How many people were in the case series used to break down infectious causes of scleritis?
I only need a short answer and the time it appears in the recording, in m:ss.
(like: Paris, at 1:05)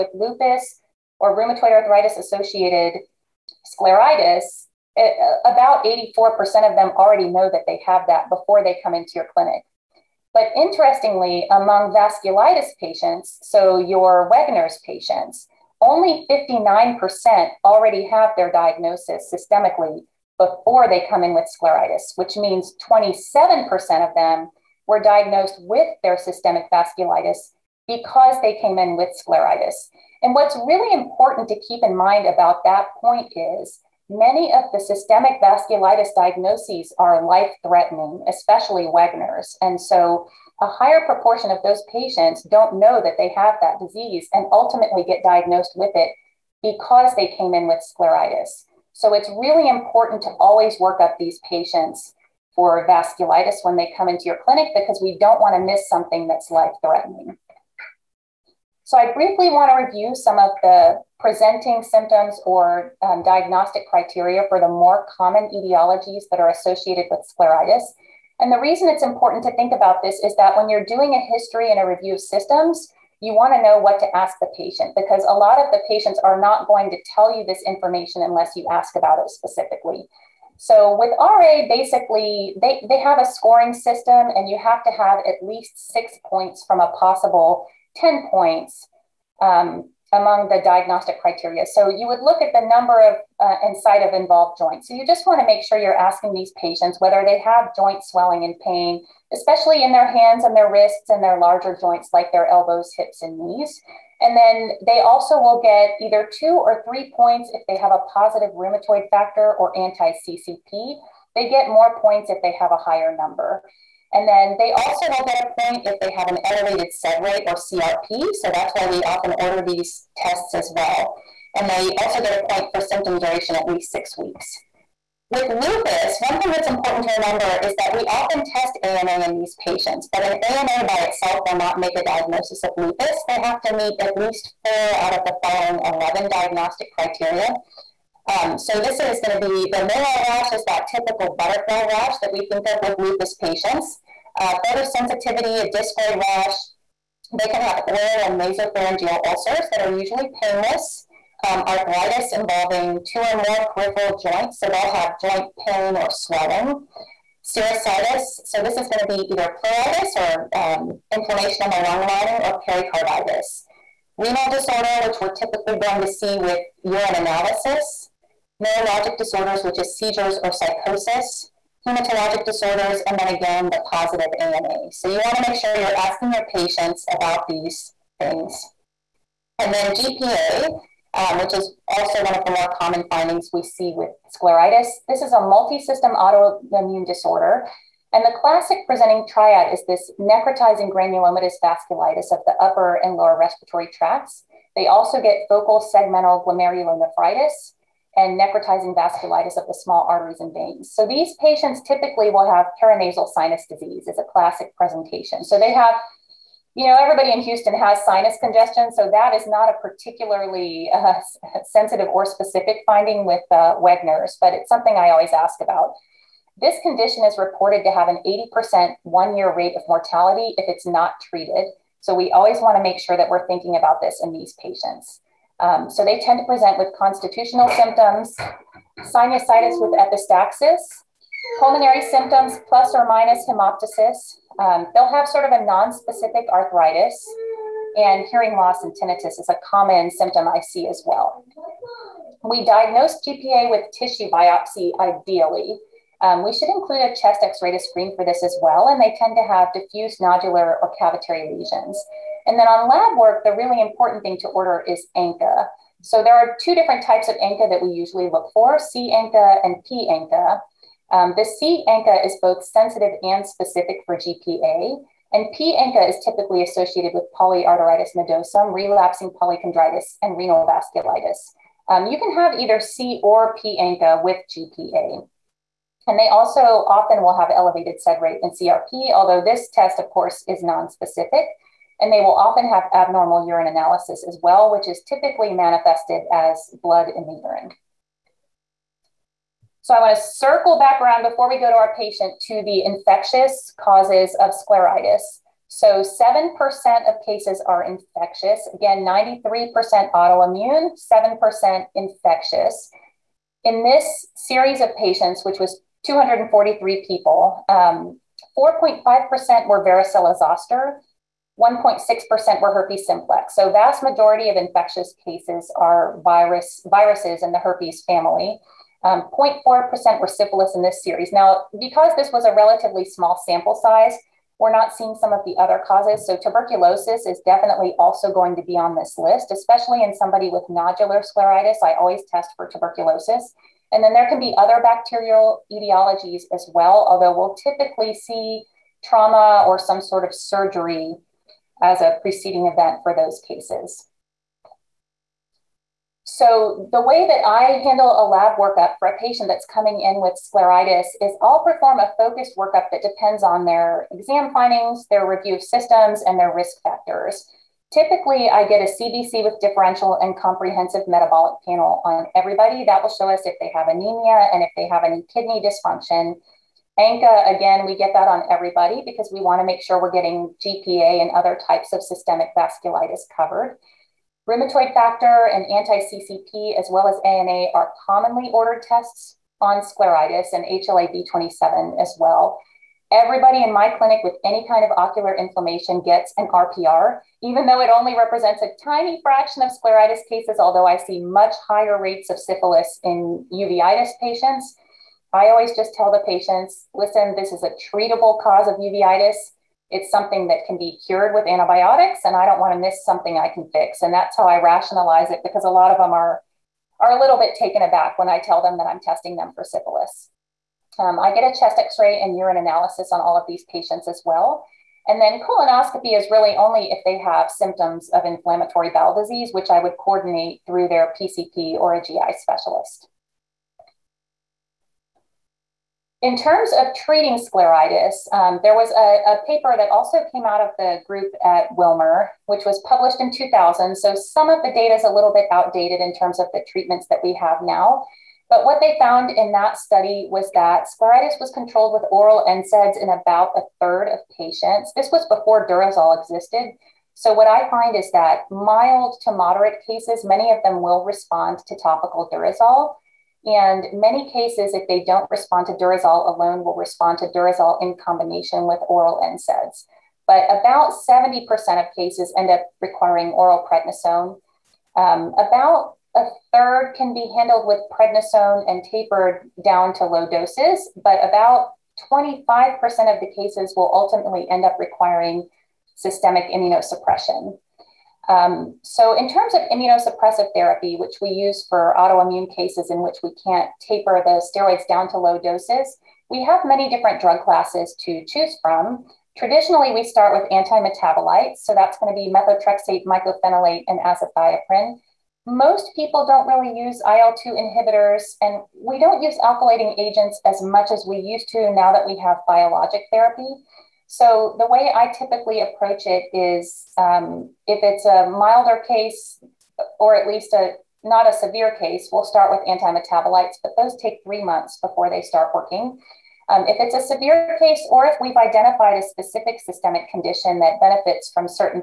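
243, at 5:06.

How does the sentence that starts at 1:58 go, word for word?
So that's why we often order these tests as well.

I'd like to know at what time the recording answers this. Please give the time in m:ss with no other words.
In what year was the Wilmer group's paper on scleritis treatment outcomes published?
7:13.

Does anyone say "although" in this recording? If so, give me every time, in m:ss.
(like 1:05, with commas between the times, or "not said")
4:39, 5:37, 6:30.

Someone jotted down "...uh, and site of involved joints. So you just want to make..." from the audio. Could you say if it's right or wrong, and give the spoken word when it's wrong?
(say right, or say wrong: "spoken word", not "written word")
right.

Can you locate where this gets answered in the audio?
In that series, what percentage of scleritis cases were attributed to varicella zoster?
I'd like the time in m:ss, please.
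5:07.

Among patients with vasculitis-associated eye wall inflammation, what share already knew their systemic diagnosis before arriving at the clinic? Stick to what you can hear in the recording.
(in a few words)
59%.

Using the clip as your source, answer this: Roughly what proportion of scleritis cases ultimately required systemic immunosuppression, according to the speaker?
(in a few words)
25%.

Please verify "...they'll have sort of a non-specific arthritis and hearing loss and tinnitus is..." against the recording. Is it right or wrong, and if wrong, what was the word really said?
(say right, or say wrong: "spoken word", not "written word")
right.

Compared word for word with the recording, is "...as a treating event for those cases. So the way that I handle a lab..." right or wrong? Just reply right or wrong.
wrong.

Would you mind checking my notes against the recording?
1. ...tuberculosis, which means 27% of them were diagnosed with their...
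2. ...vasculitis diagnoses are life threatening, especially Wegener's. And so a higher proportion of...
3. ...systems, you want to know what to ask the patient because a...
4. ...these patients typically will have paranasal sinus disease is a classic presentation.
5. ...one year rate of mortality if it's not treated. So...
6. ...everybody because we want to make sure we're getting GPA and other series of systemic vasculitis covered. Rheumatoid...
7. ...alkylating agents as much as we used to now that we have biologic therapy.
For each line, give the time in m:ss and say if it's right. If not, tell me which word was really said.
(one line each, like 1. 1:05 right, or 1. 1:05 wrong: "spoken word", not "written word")
1. 0:21 wrong: "scleritis", not "tuberculosis"
2. 0:35 right
3. 1:12 right
4. 3:21 right
5. 3:39 right
6. 6:08 wrong: "types", not "series"
7. 8:19 right.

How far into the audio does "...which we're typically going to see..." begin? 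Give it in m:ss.
2:45.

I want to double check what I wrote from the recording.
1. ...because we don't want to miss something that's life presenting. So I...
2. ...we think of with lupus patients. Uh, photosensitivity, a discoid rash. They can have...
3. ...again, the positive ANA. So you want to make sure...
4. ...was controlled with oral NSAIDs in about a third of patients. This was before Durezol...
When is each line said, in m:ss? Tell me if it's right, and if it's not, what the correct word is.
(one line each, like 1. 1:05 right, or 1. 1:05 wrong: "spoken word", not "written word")
1. 0:54 wrong: "threatening", not "presenting"
2. 2:22 right
3. 2:53 right
4. 7:21 right.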